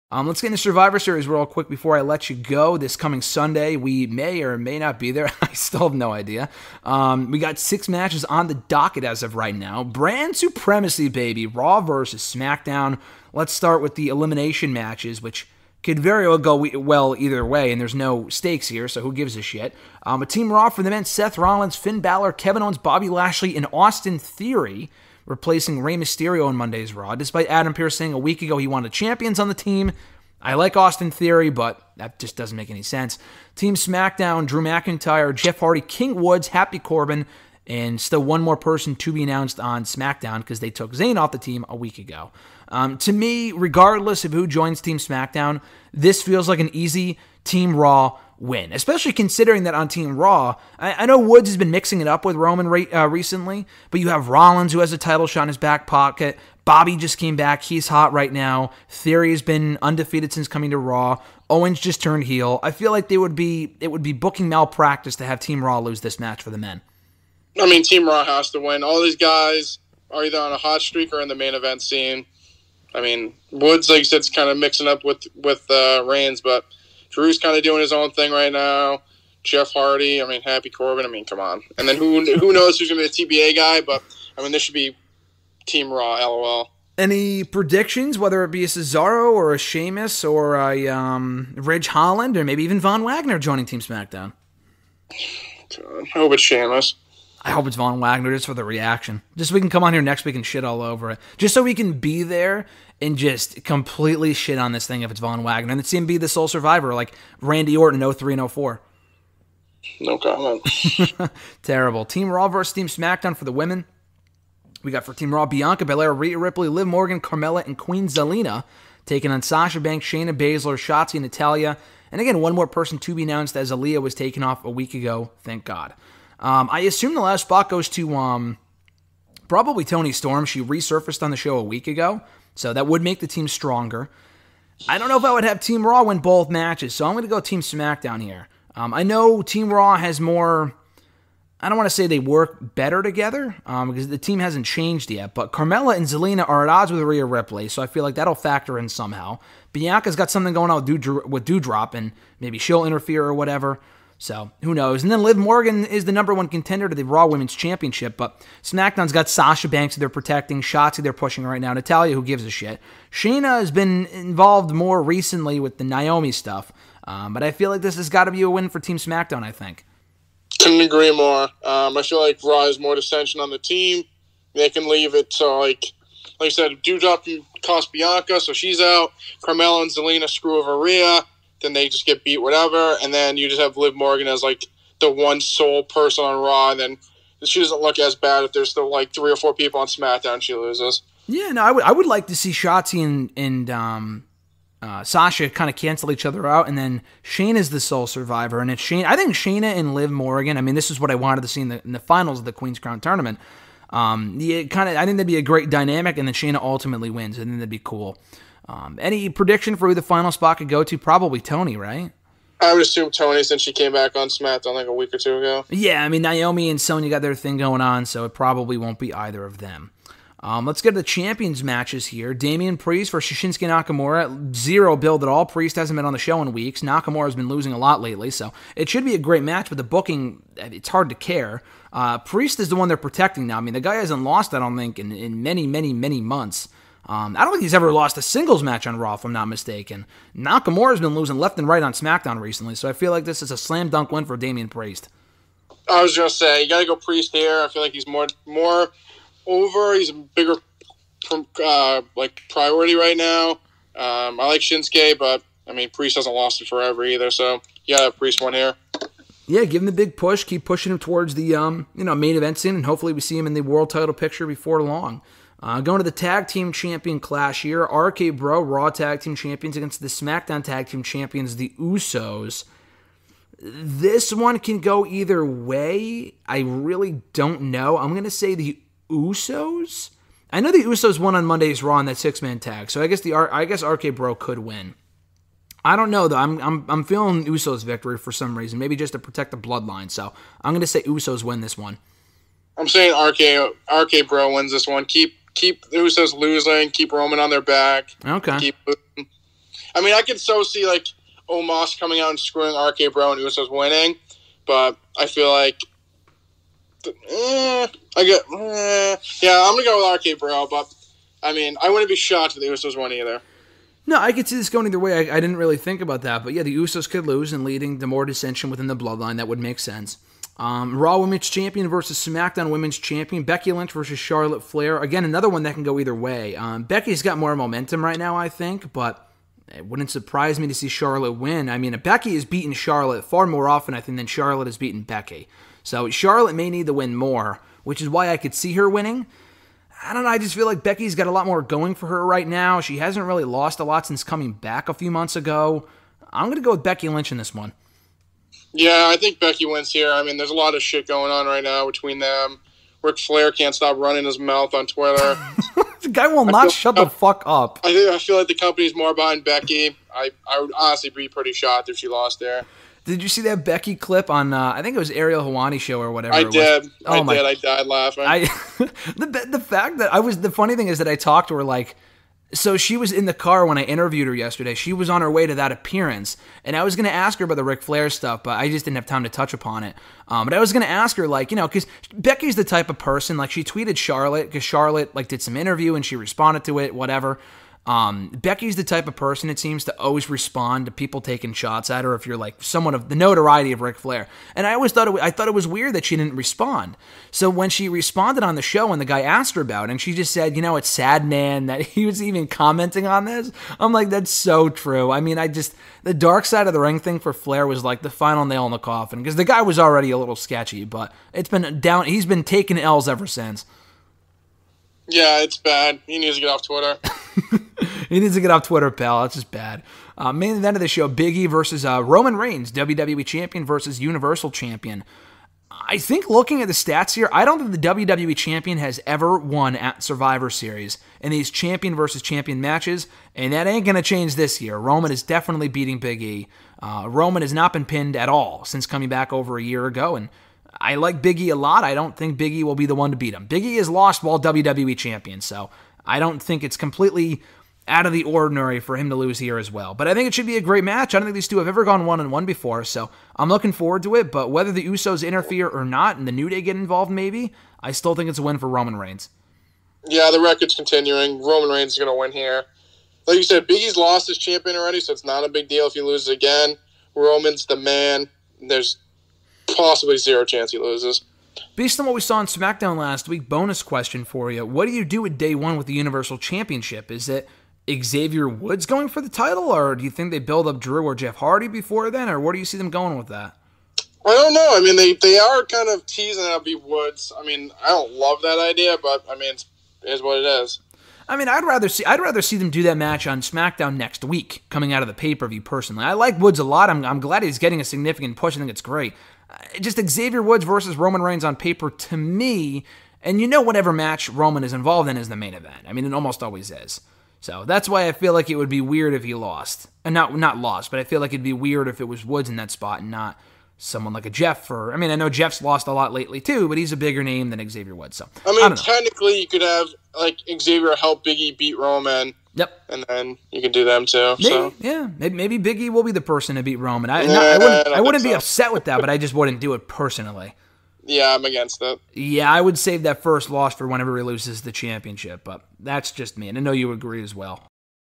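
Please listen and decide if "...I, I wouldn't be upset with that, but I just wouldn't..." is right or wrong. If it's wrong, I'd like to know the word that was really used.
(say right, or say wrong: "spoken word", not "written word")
right.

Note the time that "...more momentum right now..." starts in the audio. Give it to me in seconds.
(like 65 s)
327 s.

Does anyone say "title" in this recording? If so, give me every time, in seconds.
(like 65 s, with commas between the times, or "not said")
54 s, 263 s, 479 s.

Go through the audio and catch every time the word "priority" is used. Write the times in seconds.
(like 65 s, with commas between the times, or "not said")
252 s.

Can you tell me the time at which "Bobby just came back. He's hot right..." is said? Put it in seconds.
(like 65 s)
56 s.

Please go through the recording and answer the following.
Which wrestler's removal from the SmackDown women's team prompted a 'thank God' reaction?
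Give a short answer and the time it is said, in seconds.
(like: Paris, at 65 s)
Aliyah, at 123 s.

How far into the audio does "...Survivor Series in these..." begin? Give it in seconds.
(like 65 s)
430 s.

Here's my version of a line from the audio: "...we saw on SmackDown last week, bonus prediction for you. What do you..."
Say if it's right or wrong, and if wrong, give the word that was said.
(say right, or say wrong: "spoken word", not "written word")
wrong: "question", not "prediction".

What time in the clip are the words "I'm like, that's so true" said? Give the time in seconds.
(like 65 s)
403 s.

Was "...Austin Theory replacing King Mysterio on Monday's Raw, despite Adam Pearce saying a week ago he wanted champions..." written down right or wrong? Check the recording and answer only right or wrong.
wrong.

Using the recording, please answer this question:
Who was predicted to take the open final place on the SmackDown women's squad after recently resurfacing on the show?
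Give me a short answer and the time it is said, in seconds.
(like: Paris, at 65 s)
Toni Storm, at 129 s.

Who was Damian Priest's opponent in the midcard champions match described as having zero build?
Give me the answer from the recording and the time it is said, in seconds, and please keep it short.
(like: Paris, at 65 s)
Shinsuke Nakamura, at 223 s.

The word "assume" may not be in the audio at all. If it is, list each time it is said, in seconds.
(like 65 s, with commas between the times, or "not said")
126 s, 212 s.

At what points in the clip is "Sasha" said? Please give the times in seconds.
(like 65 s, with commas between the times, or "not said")
119 s, 159 s, 195 s.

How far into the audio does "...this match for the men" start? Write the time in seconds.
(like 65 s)
66 s.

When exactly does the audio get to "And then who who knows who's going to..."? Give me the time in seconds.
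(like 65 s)
81 s.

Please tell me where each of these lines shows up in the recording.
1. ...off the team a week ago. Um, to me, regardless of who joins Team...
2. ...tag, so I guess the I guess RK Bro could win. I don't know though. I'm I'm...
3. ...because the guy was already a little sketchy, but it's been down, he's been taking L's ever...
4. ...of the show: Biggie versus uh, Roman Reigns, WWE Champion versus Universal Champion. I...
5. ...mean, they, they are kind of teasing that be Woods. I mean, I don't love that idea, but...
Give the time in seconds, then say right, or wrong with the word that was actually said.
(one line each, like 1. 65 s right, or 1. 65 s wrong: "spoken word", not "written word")
1. 41 s right
2. 282 s right
3. 409 s right
4. 420 s right
5. 484 s right.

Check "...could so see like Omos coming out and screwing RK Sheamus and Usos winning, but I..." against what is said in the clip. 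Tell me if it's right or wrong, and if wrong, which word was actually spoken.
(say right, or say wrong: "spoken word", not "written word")
wrong: "Bro", not "Sheamus".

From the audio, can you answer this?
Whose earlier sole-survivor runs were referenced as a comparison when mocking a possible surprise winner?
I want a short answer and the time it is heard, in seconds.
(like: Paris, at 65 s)
Randy Orton, at 107 s.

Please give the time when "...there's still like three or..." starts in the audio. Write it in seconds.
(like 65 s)
188 s.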